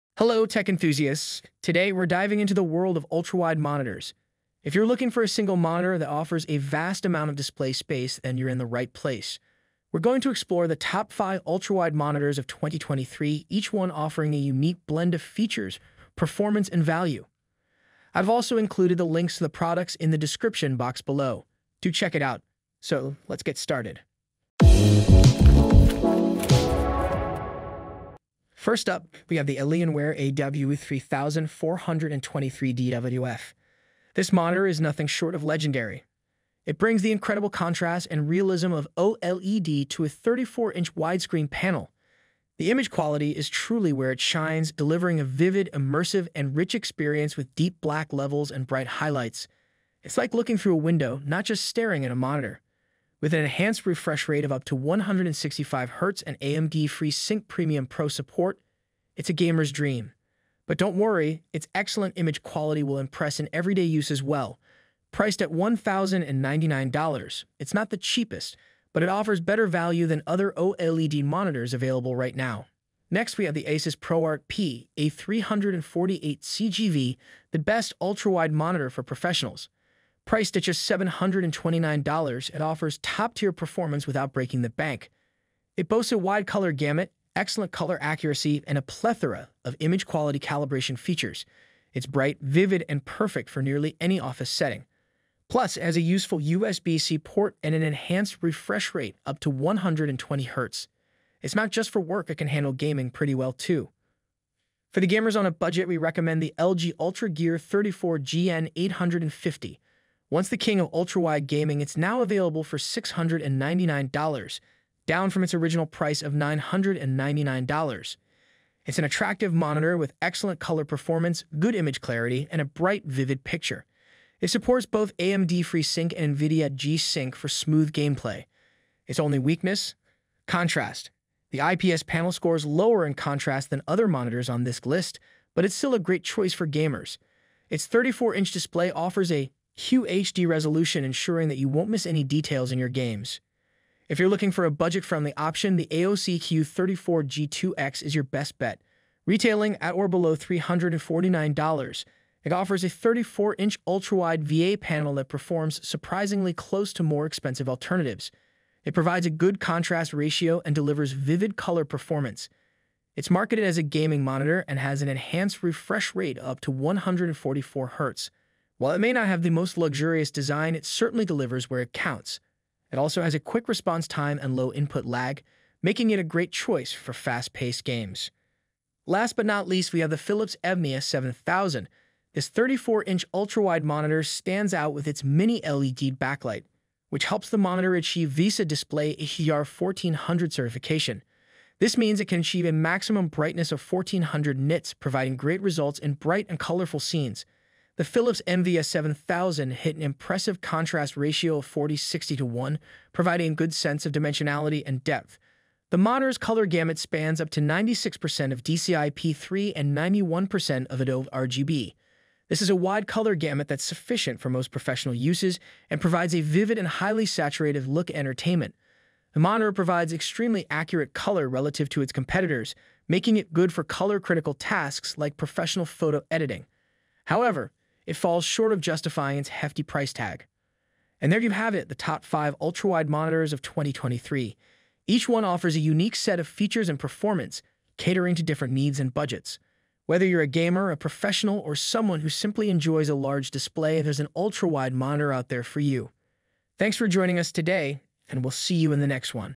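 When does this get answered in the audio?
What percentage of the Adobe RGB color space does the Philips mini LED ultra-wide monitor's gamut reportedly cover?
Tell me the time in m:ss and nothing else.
3:29.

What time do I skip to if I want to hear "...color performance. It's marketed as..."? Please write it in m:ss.
2:41.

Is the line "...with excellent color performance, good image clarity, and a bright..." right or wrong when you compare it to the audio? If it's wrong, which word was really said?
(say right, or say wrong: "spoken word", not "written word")
right.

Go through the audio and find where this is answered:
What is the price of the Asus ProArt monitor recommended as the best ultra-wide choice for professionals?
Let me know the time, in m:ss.
1:20.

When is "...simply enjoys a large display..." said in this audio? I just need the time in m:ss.
4:02.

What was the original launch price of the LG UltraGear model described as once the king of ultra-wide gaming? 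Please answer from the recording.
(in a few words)
$999.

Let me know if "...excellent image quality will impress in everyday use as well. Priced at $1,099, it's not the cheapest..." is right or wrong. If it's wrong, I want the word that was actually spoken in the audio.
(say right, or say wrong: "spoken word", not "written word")
right.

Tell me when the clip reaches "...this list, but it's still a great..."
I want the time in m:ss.
2:14.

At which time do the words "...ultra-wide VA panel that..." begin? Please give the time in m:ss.
2:33.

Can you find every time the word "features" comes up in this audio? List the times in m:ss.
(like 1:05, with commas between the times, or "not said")
0:15, 1:30, 3:56.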